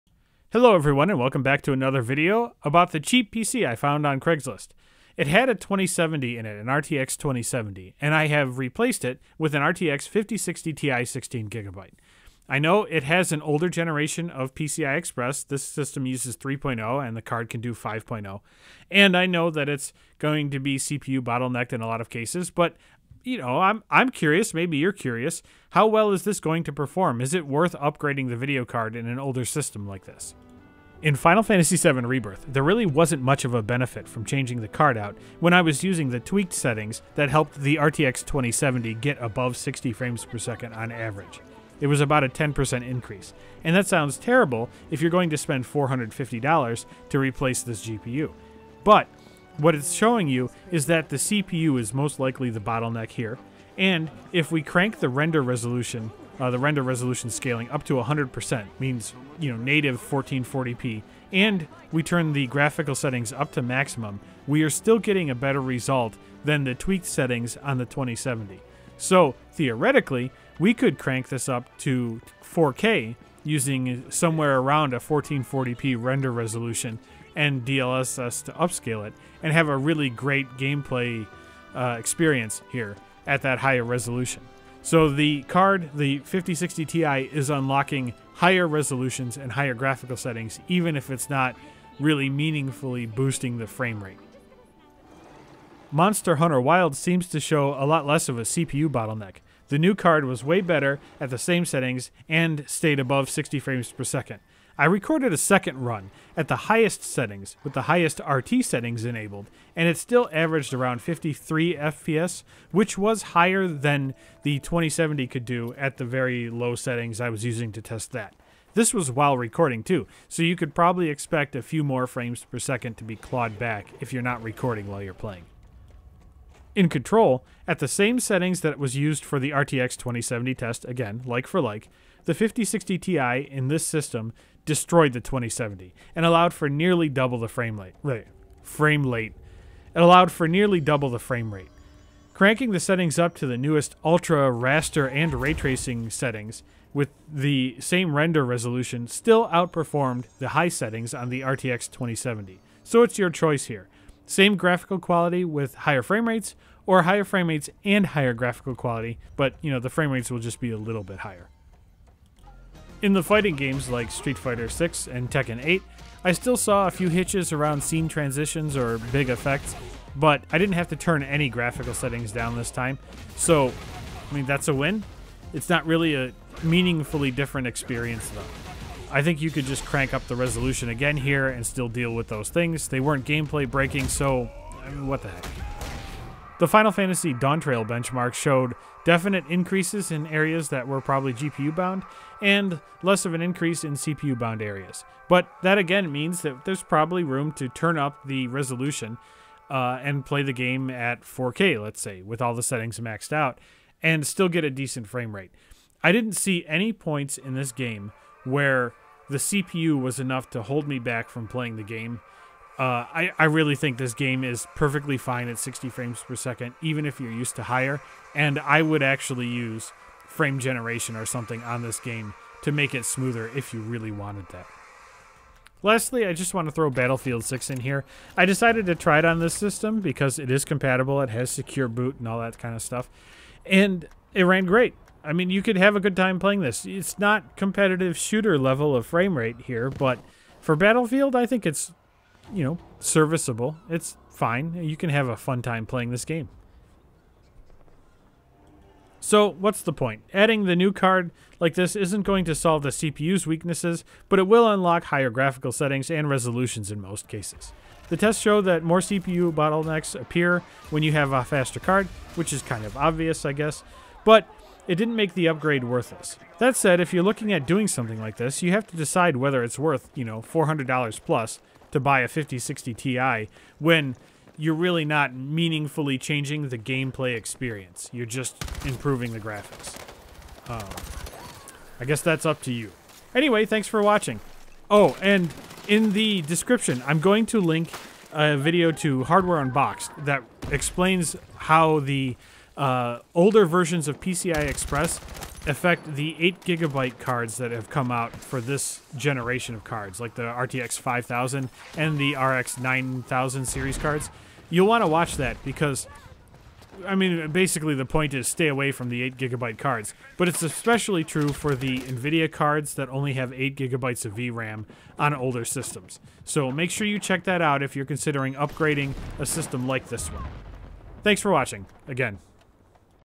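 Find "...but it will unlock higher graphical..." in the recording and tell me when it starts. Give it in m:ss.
4:14.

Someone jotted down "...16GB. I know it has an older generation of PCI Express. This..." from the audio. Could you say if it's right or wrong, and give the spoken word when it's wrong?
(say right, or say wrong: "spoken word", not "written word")
right.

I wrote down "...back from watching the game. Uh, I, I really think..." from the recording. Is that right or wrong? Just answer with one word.
wrong.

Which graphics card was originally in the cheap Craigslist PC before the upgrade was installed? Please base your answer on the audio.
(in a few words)
RTX 2070.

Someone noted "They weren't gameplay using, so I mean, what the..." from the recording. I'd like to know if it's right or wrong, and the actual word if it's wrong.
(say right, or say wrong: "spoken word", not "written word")
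wrong: "breaking", not "using".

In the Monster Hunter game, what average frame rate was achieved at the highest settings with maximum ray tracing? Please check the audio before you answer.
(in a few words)
53 FPS.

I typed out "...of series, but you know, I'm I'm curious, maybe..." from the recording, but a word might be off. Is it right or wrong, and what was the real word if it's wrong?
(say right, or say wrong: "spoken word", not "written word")
wrong: "cases", not "series".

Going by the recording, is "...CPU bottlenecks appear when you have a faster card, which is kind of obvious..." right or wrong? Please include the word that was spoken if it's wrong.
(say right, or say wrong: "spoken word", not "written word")
right.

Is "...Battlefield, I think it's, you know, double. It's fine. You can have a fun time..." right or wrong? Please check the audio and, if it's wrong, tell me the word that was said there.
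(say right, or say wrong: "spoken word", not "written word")
wrong: "serviceable", not "double".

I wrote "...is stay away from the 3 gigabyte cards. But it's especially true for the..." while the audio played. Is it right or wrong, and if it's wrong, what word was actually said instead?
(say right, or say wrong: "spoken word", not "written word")
wrong: "8", not "3".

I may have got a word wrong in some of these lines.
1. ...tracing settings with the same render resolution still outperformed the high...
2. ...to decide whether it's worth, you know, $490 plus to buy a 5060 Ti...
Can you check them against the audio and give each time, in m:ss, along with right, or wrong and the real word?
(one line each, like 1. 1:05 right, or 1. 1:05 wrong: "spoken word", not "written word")
1. 2:25 right
2. 4:28 wrong: "400", not "490".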